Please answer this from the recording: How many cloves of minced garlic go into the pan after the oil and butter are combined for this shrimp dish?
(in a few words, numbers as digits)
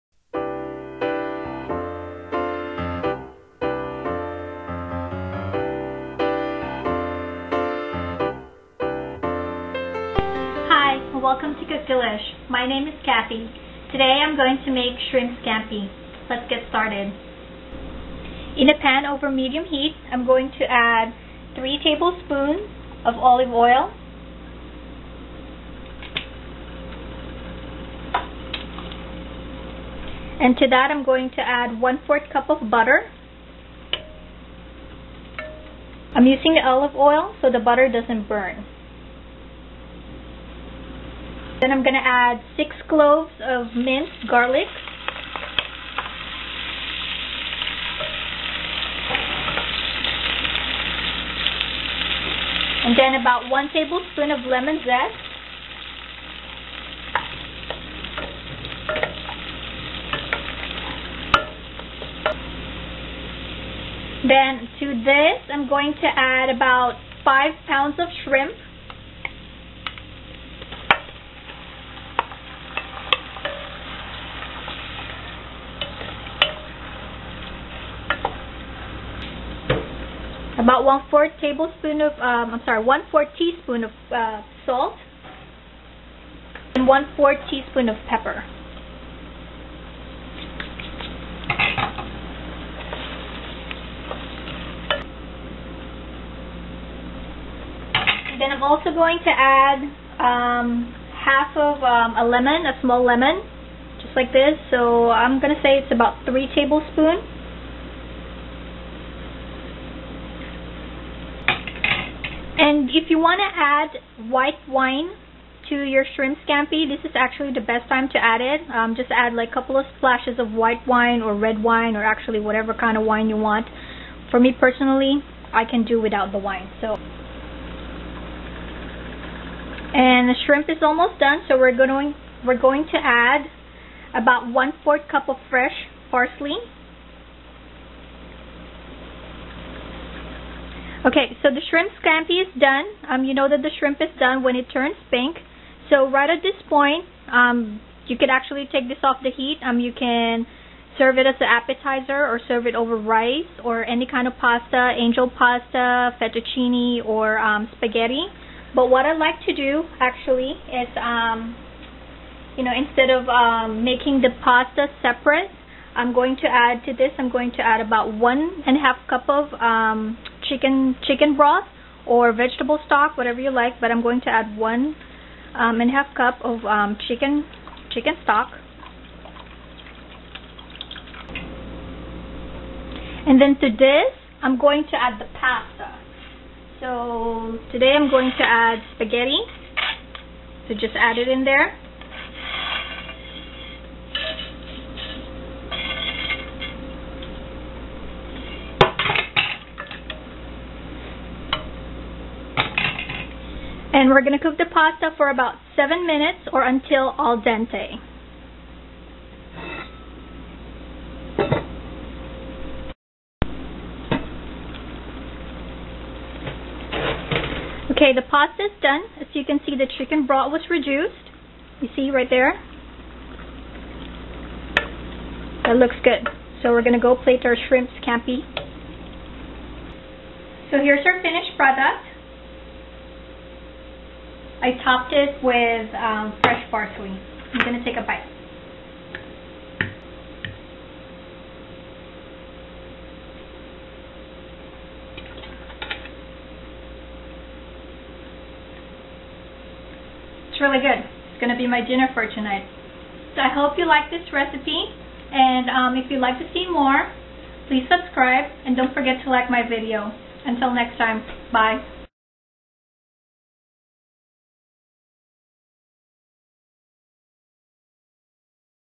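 6.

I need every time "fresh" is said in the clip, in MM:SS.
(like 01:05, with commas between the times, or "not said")
02:15, 03:56.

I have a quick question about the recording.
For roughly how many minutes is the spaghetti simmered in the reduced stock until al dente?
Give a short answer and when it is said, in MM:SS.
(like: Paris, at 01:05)
7 minutes, at 03:25.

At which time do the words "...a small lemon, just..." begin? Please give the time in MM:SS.
01:42.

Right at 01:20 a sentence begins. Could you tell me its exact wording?
about one fourth tablespoon of um, I'm sorry one fourth teaspoon of uh, salt and one fourth teaspoon of pepper.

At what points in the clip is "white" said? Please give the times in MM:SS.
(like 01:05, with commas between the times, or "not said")
01:54, 02:00.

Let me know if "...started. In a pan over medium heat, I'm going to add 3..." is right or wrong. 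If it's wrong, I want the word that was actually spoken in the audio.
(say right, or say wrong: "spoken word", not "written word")
right.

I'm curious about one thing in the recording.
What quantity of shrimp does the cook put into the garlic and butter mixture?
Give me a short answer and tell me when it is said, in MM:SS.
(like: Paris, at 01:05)
5 pounds, at 01:07.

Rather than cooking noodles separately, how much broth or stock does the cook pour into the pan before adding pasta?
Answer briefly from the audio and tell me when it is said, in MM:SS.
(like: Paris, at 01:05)
1.5 cups, at 02:48.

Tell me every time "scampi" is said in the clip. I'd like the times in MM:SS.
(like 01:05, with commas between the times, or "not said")
00:15, 01:56, 02:22, 03:48.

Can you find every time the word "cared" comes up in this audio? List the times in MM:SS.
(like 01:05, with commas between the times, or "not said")
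not said.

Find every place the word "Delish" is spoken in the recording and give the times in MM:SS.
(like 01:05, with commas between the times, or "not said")
00:11.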